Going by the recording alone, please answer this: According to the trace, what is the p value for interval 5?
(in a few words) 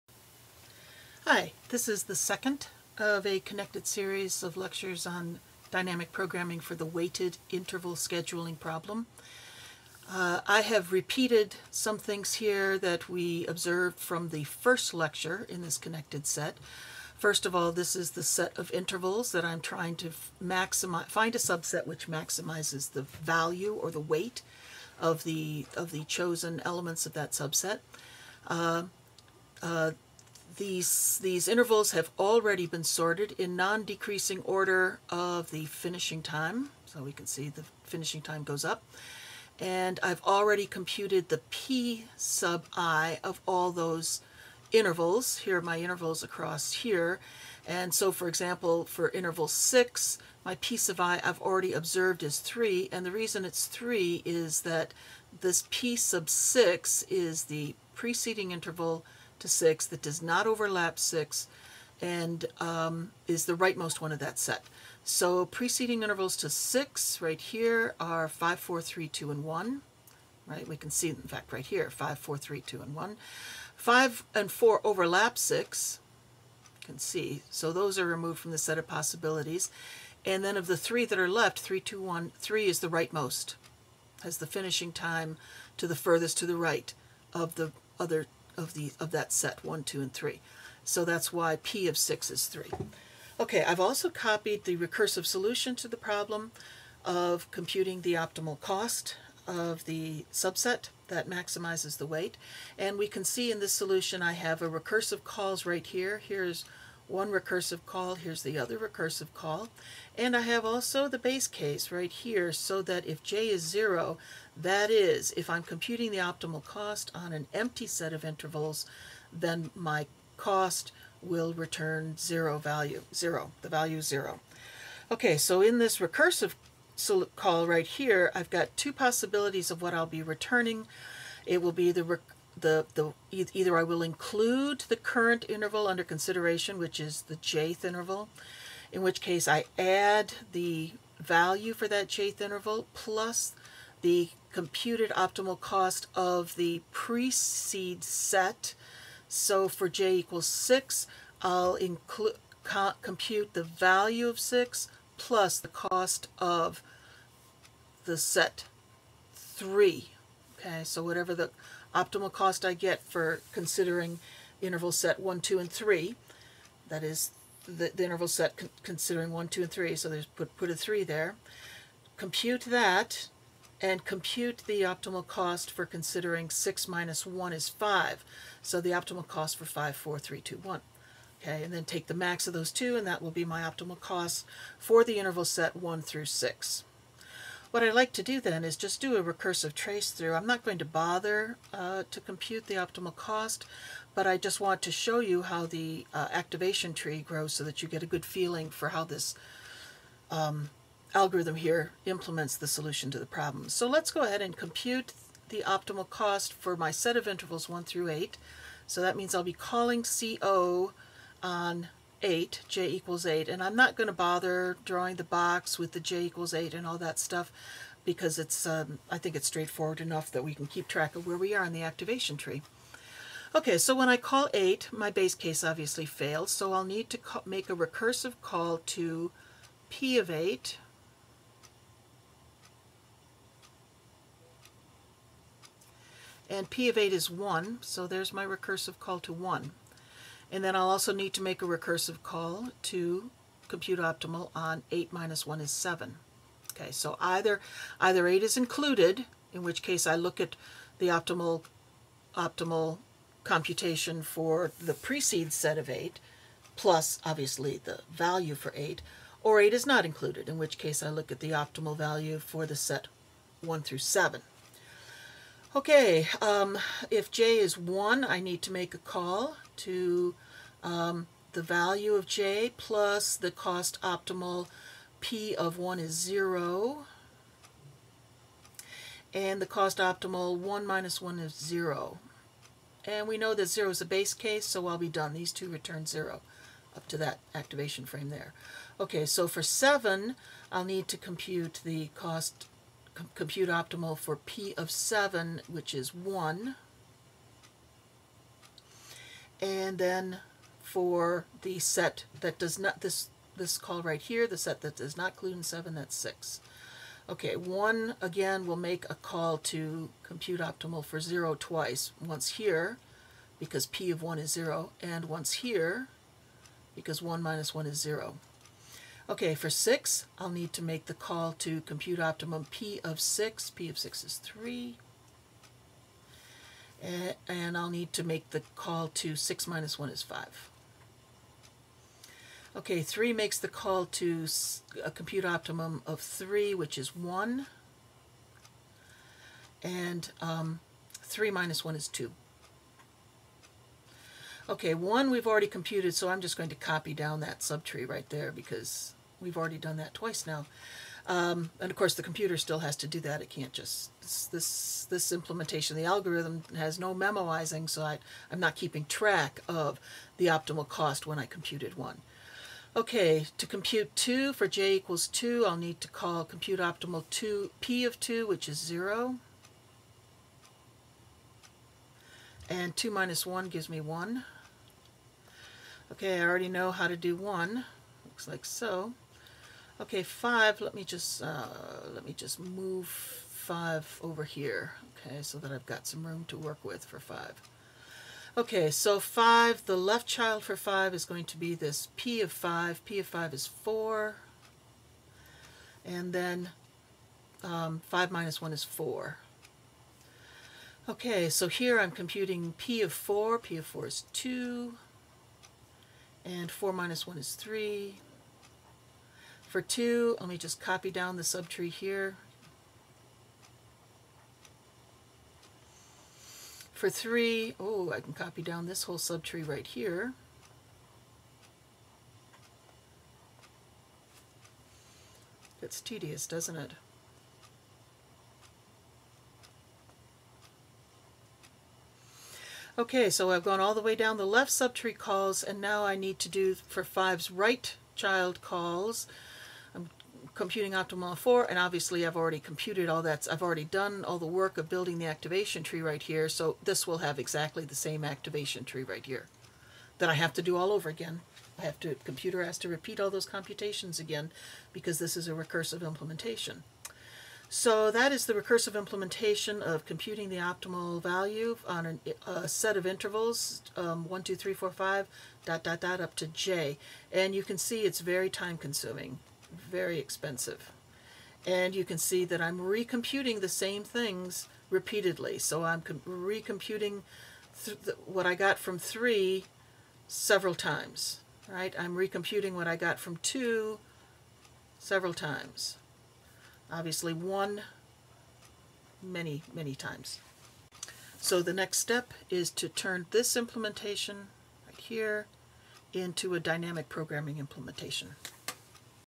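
4.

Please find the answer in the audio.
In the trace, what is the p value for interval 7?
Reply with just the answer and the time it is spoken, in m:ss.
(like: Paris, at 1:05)
1, at 4:54.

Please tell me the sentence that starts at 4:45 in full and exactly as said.
These two return 0 up to that activation frame there.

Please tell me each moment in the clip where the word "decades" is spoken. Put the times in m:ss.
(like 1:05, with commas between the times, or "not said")
not said.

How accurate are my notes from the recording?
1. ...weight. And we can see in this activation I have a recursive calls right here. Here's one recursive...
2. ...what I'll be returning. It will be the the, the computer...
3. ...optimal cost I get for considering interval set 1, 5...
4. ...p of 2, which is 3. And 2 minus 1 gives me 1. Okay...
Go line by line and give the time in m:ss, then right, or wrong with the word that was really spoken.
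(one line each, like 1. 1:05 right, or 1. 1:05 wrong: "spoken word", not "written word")
1. 1:42 wrong: "solution", not "activation"
2. 2:09 wrong: "either", not "computer"
3. 2:41 wrong: "2", not "5"
4. 6:07 wrong: "0", not "3".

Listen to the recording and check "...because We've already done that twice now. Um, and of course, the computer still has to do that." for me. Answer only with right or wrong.
right.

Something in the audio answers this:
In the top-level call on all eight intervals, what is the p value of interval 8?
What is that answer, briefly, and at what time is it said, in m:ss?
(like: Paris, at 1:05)
1, at 3:56.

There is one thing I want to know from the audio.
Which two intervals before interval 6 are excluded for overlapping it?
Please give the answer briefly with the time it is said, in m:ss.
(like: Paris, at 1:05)
5 and 4, at 1:13.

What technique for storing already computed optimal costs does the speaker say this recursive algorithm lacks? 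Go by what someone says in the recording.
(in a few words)
Memoizing.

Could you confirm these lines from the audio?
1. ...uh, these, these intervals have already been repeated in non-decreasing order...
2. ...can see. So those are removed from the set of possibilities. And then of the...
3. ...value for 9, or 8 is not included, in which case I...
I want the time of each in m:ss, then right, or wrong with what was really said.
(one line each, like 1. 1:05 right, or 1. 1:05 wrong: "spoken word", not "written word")
1. 0:29 wrong: "sorted", not "repeated"
2. 1:16 right
3. 4:18 wrong: "8", not "9".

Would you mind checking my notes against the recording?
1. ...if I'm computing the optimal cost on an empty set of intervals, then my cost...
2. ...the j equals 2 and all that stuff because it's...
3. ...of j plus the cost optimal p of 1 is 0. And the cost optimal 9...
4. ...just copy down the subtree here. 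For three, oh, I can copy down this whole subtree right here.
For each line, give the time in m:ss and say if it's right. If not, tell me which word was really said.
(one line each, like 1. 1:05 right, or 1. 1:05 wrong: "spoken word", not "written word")
1. 1:55 right
2. 3:35 wrong: "8", not "2"
3. 4:32 wrong: "1", not "9"
4. 6:50 right.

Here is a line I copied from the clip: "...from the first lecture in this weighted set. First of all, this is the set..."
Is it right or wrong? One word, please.
wrong.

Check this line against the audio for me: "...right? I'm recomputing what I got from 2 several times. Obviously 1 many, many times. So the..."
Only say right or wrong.
right.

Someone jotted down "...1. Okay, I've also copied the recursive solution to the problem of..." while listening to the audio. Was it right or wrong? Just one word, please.
wrong.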